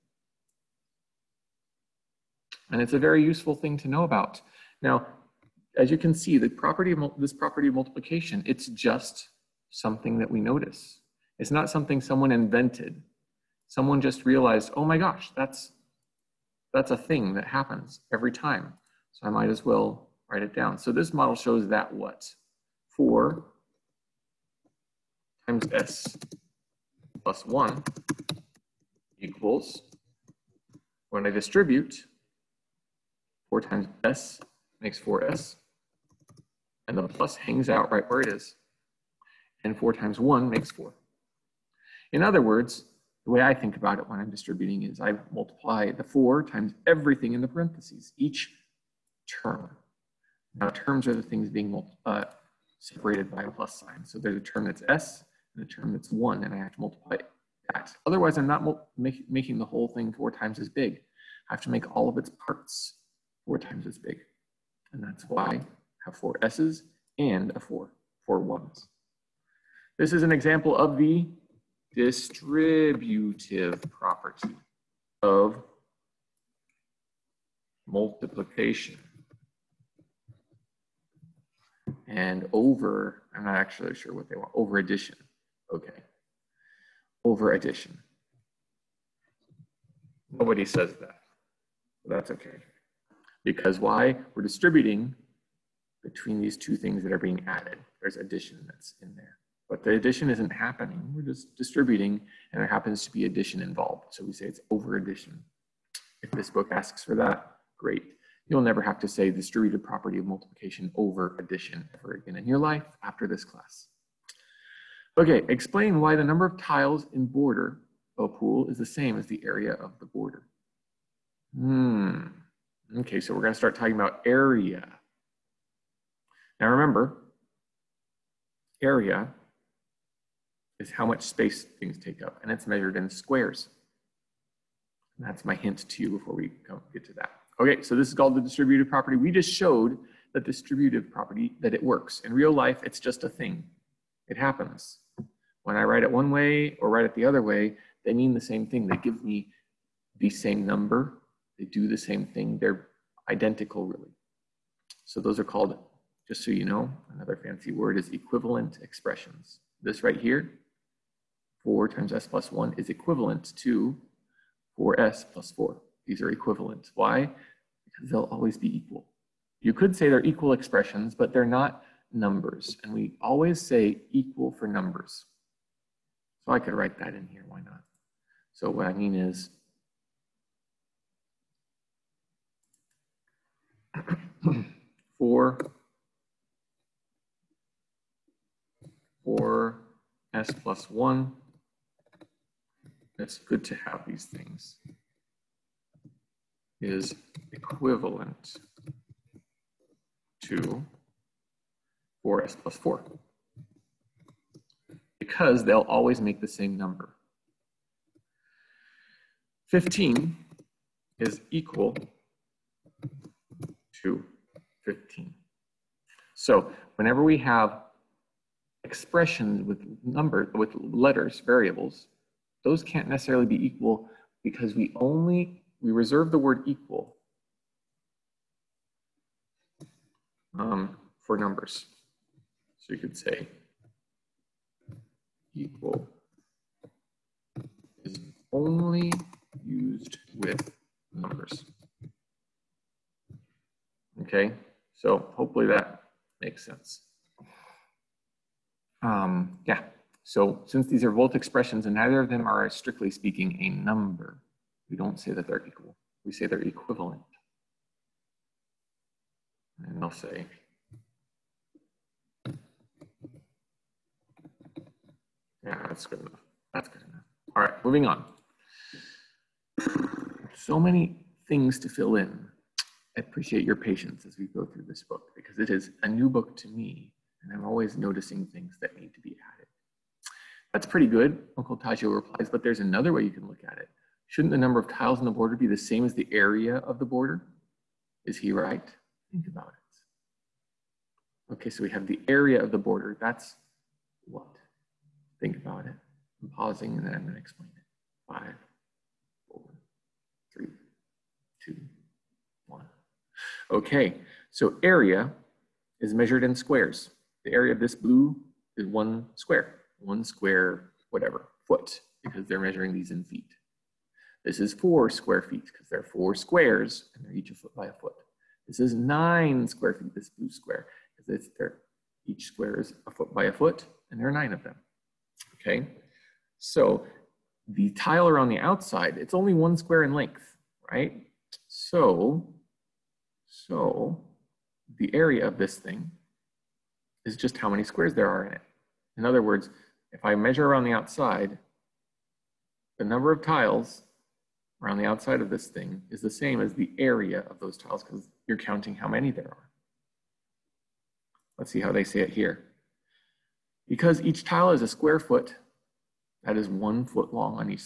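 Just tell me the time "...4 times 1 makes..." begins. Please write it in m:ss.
0:39.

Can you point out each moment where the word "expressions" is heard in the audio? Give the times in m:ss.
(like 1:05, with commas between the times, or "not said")
2:38, 2:50, 3:38, 4:11.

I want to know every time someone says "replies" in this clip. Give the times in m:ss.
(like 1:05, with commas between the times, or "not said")
4:42.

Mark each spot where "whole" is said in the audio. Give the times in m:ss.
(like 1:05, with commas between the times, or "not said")
0:59.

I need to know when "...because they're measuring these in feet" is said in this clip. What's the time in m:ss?
5:12.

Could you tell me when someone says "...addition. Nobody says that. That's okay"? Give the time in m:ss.
1:27.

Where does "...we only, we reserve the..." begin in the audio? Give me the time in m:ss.
3:44.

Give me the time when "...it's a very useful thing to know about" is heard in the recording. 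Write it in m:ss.
0:02.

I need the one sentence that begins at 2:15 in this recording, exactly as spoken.
And that's my hint to you before we get to that.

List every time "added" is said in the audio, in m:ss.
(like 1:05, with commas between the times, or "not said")
1:37, 4:39.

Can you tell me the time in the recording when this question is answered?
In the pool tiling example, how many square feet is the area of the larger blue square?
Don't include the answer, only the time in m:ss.
5:18.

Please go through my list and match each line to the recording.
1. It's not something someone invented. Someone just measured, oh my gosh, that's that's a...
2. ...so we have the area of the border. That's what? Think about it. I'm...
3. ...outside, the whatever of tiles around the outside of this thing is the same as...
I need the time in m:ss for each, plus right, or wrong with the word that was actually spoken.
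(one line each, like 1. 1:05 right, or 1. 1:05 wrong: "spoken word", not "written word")
1. 0:11 wrong: "realized", not "measured"
2. 4:51 right
3. 5:40 wrong: "number", not "whatever".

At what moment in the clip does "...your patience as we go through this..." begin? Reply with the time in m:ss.
4:33.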